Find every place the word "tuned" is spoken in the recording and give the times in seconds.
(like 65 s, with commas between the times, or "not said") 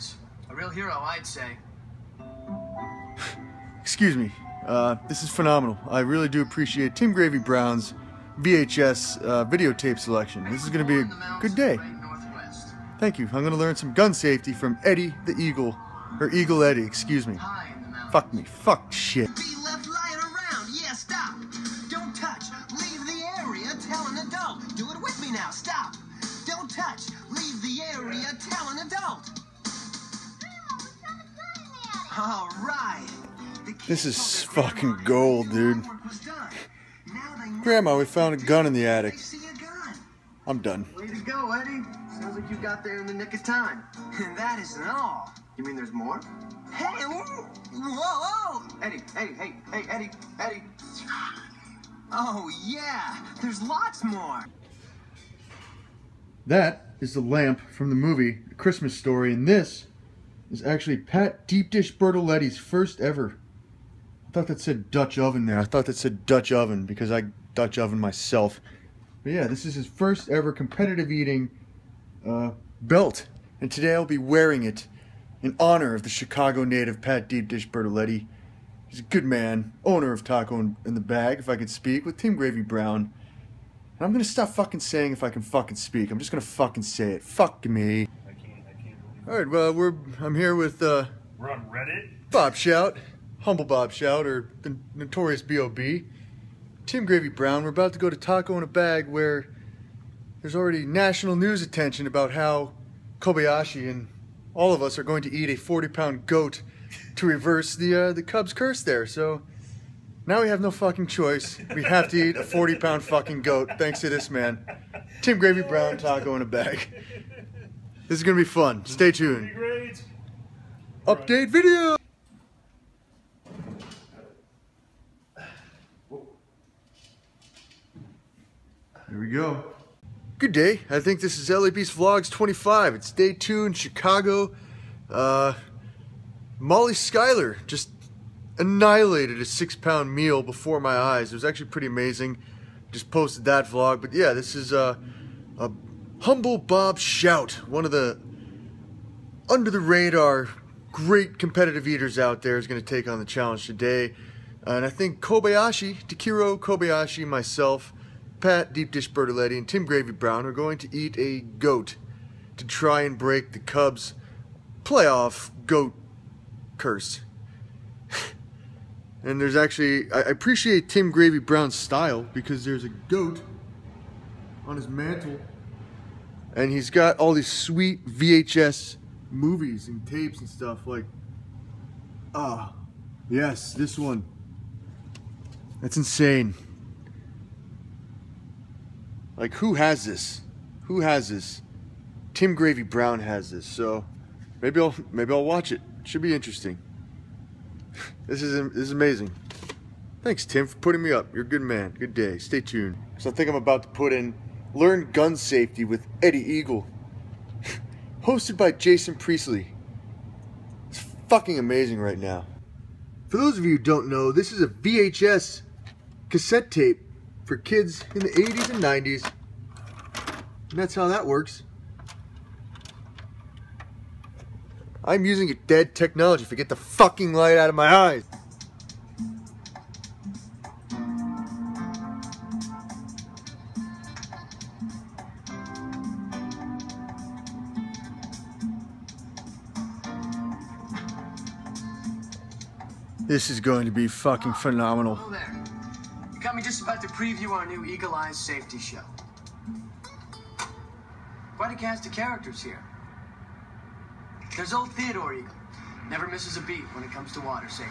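119 s, 202 s.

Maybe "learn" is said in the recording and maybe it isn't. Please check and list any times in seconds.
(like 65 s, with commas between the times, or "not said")
13 s, 204 s.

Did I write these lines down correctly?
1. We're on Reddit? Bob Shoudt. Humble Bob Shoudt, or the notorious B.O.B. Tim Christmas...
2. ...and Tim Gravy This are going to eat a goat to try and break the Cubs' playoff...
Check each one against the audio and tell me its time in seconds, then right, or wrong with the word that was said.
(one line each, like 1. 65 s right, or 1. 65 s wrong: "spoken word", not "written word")
1. 91 s wrong: "Gravy", not "Christmas"
2. 159 s wrong: "Brown", not "This".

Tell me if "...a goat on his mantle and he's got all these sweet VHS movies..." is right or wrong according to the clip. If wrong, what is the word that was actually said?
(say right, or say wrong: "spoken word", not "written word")
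right.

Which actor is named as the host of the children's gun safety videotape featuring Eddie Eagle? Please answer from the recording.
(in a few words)
Jason Priestley.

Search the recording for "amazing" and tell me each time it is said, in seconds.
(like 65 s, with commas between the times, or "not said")
141 s, 198 s, 211 s.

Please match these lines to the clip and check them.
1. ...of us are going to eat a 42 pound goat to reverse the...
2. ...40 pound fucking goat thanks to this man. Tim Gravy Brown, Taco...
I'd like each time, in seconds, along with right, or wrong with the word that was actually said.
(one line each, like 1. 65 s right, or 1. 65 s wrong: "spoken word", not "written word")
1. 104 s wrong: "40", not "42"
2. 112 s right.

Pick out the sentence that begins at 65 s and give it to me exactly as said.
I thought that said Dutch oven because I Dutch oven myself.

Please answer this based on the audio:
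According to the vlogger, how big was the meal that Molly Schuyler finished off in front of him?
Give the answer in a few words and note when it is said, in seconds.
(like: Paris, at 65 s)
6 pounds, at 139 s.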